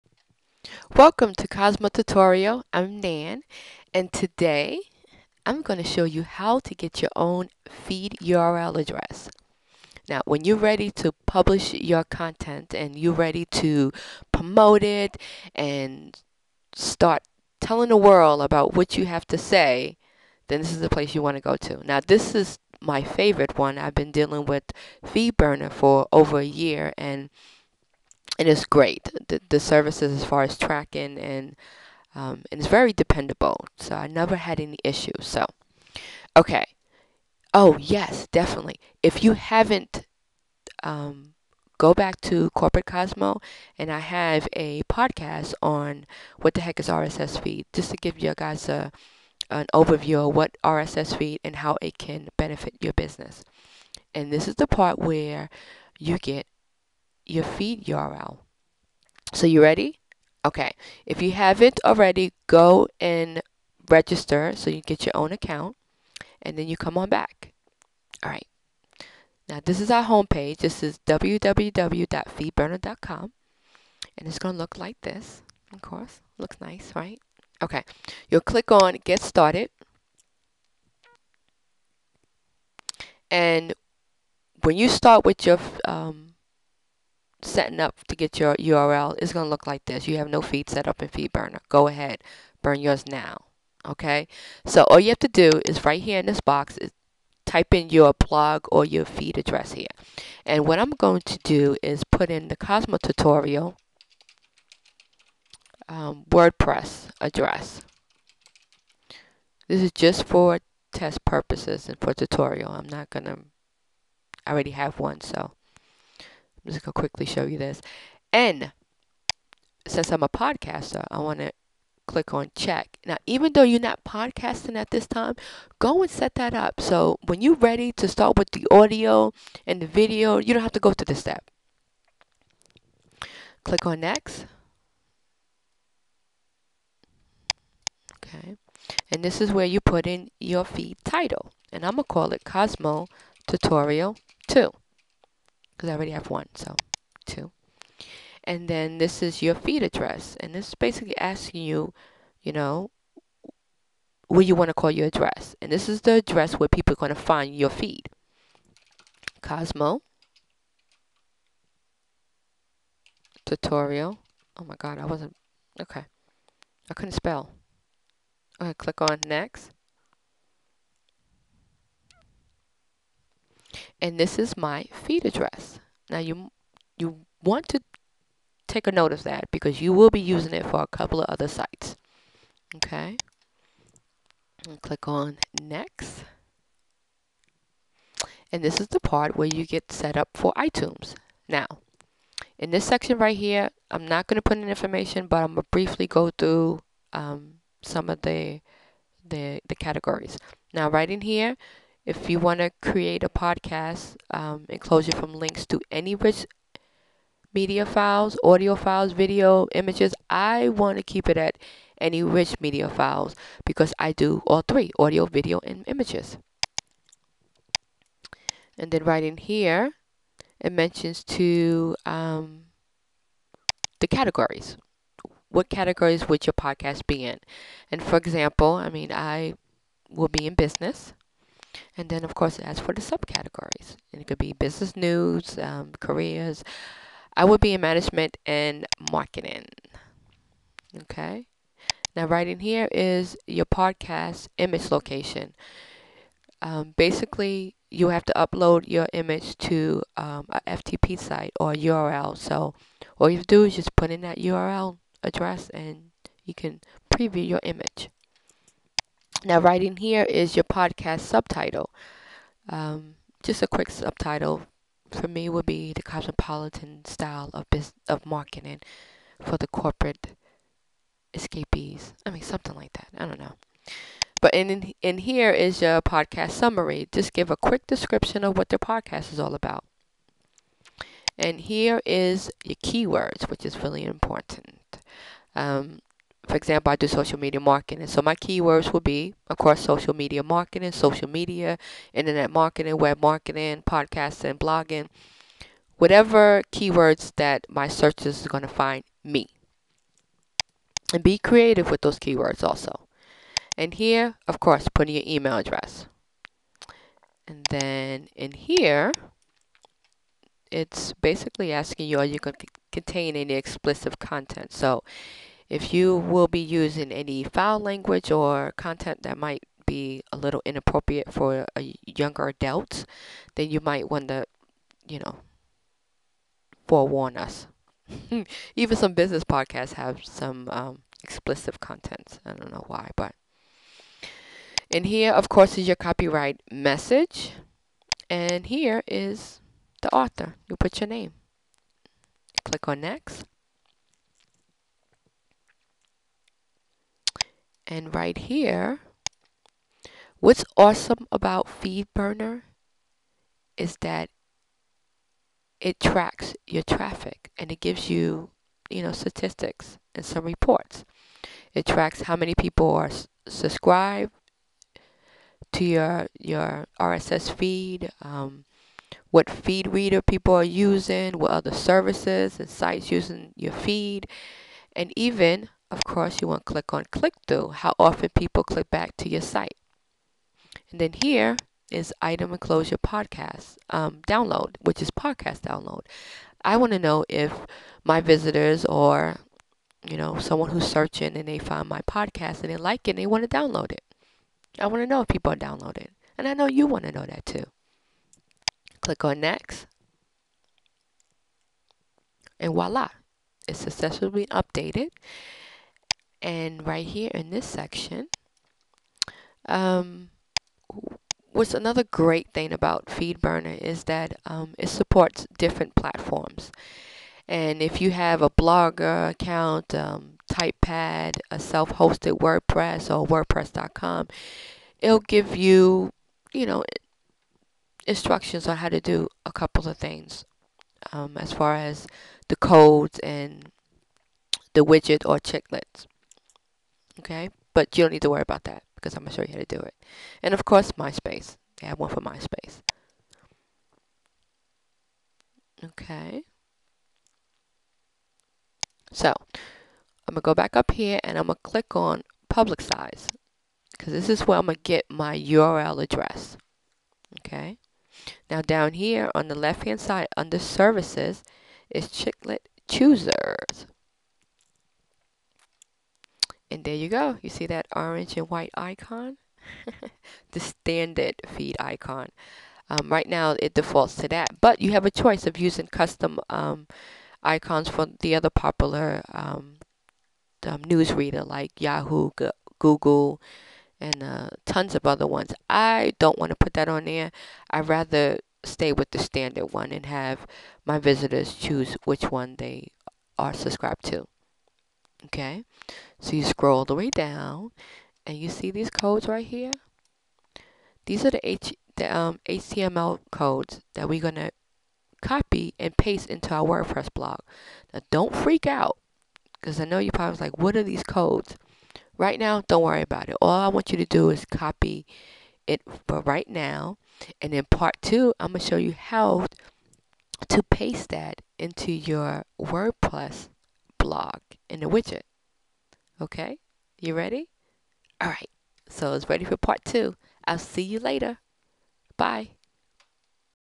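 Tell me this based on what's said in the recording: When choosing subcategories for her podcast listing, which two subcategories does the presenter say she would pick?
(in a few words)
management and marketing.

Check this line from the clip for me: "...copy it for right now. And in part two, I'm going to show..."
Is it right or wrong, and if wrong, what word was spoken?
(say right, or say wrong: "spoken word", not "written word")
right.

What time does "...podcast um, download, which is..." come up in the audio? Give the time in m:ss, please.
6:22.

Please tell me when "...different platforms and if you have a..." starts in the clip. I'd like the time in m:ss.
6:55.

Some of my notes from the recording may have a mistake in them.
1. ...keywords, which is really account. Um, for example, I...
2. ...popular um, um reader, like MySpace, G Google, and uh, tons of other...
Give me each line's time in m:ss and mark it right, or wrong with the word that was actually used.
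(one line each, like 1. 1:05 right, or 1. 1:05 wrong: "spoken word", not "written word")
1. 4:42 wrong: "important", not "account"
2. 7:58 wrong: "Yahoo", not "MySpace".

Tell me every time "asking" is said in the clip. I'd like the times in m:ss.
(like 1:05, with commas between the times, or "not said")
2:31, 5:11.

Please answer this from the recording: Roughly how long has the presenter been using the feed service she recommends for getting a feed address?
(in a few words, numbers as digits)
over a year.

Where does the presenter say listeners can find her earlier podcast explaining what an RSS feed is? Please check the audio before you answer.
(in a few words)
Corporate Cosmo.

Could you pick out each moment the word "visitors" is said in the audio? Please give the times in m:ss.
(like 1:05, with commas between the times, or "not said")
6:28, 8:10.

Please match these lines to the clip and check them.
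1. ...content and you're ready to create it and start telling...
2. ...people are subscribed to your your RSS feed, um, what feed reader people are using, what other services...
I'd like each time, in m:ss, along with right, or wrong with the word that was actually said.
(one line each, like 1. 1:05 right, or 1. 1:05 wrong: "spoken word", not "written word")
1. 0:12 wrong: "promote", not "create"
2. 6:02 right.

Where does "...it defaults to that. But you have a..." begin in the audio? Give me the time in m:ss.
7:53.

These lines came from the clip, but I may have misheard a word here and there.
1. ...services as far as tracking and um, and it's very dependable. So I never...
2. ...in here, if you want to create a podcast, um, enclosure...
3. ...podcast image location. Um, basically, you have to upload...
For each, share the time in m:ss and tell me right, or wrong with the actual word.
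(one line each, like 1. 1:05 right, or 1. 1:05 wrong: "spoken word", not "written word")
1. 0:29 right
2. 3:21 right
3. 4:03 right.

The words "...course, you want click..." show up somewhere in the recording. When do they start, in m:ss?
6:16.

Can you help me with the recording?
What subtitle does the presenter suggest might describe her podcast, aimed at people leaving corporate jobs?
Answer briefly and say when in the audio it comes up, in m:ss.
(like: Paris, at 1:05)
the cosmopolitan style of business, at 4:25.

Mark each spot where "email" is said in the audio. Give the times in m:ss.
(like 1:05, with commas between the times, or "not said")
5:05.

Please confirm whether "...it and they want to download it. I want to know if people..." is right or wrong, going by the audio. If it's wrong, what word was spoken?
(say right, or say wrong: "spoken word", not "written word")
right.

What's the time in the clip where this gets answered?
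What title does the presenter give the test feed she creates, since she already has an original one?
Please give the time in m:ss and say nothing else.
2:22.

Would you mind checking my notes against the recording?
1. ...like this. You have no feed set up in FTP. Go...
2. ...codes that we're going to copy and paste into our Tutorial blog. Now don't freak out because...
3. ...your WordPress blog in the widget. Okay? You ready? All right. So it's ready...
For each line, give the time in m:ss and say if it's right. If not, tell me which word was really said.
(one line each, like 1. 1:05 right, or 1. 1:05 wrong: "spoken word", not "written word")
1. 1:29 wrong: "FeedBurner", not "FTP"
2. 8:23 wrong: "WordPress", not "Tutorial"
3. 8:41 right.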